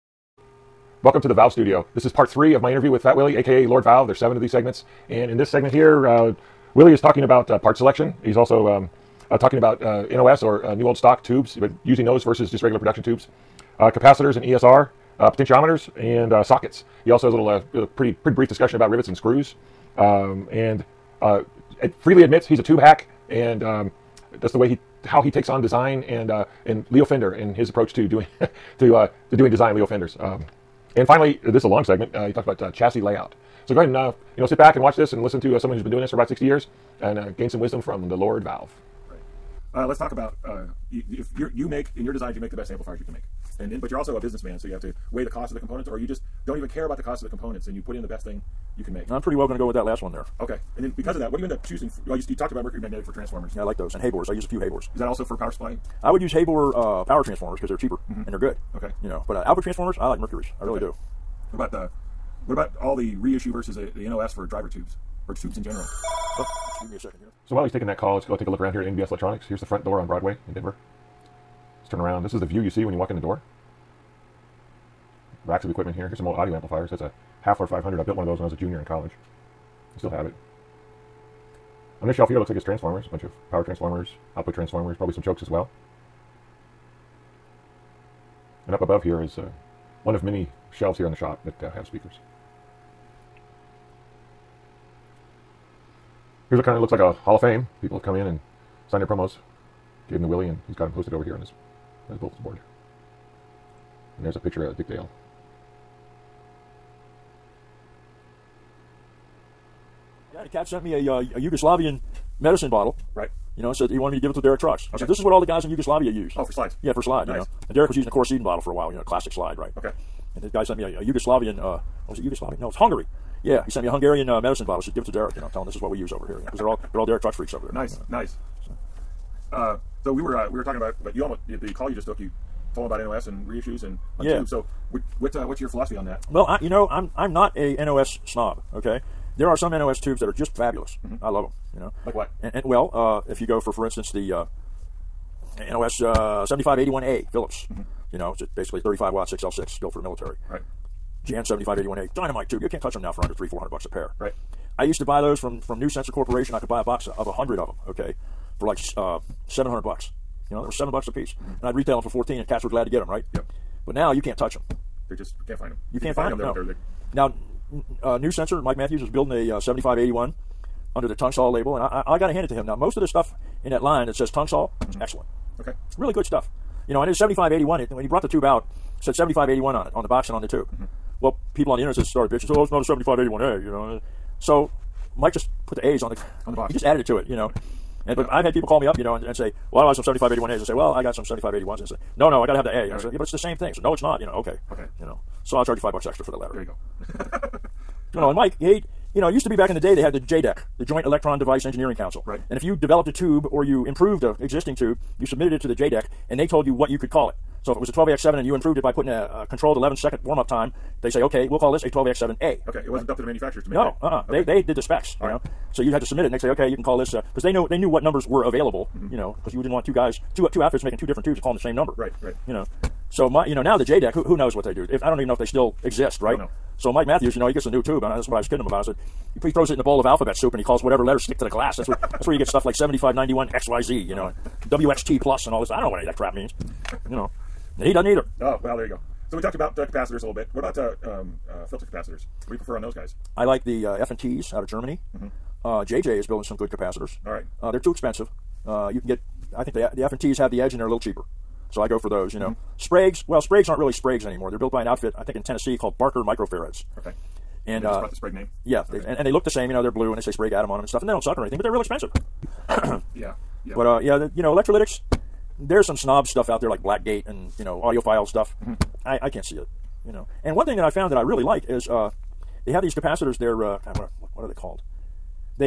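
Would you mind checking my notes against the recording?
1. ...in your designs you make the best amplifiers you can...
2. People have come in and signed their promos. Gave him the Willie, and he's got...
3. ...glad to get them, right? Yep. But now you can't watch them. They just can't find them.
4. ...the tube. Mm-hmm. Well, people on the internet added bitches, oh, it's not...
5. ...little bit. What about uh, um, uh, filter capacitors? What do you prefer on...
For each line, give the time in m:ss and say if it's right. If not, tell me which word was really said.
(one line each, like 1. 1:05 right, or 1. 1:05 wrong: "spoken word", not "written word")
1. 0:41 right
2. 1:37 right
3. 2:42 wrong: "touch", not "watch"
4. 3:00 wrong: "started", not "added"
5. 4:00 right.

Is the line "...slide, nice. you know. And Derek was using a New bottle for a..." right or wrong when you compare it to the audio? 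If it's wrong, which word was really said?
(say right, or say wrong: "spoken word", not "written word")
wrong: "Coricidin", not "New".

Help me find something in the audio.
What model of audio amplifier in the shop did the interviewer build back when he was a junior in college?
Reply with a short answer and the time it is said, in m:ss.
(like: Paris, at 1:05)
Hafler 500, at 1:17.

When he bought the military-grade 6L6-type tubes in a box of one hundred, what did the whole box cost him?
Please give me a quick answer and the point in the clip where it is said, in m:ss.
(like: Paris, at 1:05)
$700, at 2:39.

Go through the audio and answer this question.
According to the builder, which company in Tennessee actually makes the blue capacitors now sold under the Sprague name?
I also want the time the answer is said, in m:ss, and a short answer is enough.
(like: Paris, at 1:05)
Barker Microfarads, at 4:15.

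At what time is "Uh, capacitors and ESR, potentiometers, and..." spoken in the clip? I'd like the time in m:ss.
0:13.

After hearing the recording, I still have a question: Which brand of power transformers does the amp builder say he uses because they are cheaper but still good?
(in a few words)
Heyboer.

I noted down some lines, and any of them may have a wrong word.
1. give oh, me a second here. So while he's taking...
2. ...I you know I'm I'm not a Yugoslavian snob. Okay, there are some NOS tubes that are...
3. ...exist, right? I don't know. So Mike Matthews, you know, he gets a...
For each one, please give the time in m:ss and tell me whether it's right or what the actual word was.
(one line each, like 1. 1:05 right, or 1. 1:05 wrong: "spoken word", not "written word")
1. 1:06 right
2. 2:16 wrong: "NOS", not "Yugoslavian"
3. 3:45 right.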